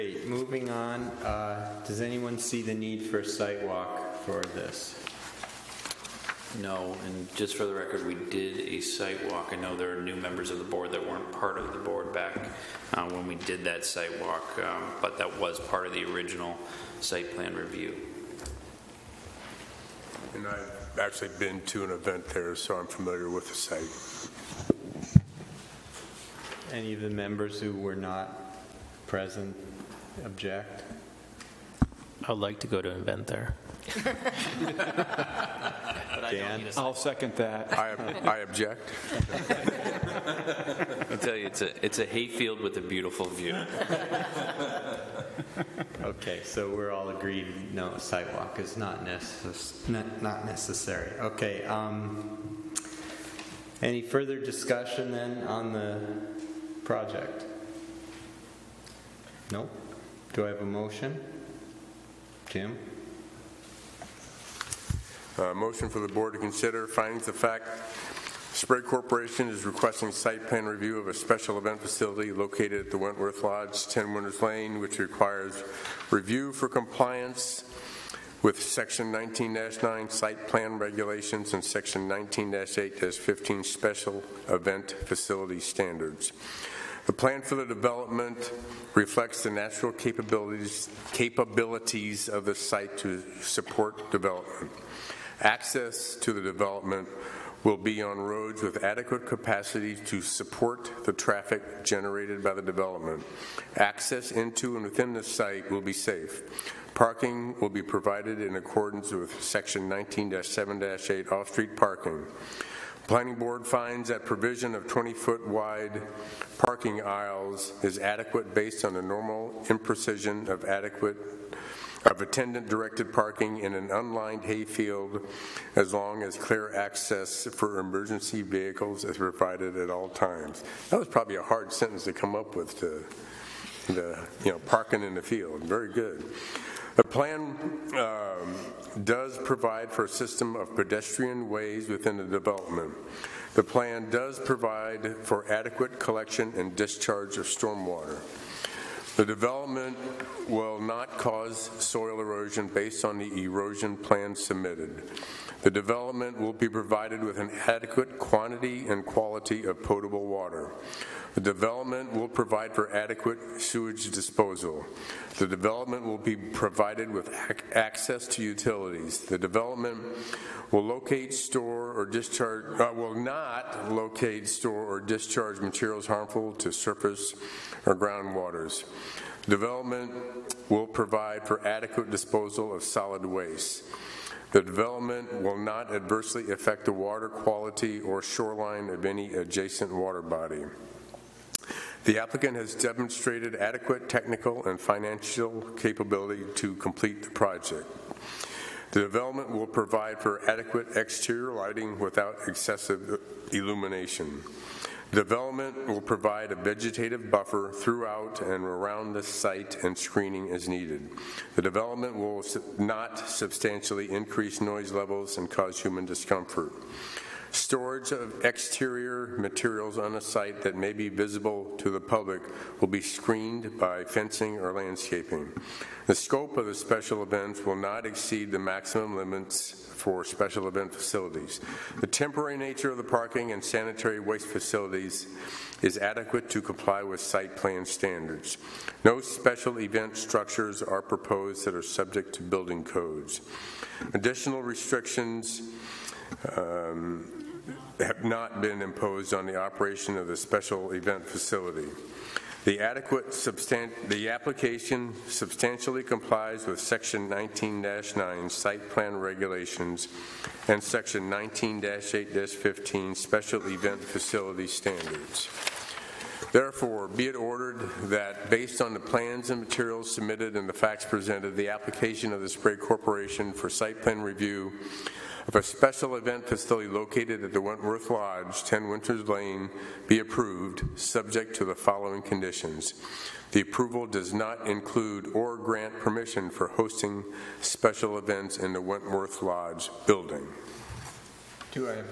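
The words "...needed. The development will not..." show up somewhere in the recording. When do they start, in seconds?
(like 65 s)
210 s.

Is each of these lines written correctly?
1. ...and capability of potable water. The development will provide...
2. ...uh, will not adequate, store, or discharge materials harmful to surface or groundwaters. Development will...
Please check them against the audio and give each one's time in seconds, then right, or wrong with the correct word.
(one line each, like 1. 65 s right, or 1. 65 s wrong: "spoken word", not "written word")
1. 158 s wrong: "quality", not "capability"
2. 172 s wrong: "locate", not "adequate".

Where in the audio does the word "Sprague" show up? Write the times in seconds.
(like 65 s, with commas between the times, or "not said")
68 s, 272 s.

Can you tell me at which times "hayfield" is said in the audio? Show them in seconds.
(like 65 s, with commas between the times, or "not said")
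42 s, 124 s.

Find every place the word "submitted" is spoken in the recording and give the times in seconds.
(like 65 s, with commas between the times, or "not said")
154 s, 270 s.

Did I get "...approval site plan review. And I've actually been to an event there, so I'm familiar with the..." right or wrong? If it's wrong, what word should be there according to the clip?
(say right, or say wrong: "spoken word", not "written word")
wrong: "original", not "approval".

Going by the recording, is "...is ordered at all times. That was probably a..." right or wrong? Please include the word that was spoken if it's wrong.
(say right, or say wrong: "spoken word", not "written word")
wrong: "provided", not "ordered".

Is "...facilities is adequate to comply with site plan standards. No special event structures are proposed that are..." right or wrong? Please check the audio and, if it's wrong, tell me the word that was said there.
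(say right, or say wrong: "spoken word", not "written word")
right.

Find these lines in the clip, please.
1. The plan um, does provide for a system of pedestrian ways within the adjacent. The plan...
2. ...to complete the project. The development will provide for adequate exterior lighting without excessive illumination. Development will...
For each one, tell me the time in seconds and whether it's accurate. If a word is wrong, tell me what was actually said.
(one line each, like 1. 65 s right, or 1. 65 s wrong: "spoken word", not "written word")
1. 136 s wrong: "development", not "adjacent"
2. 196 s right.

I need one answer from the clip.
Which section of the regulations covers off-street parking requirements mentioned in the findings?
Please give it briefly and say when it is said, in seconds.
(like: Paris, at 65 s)
Section 19-7-8, at 109 s.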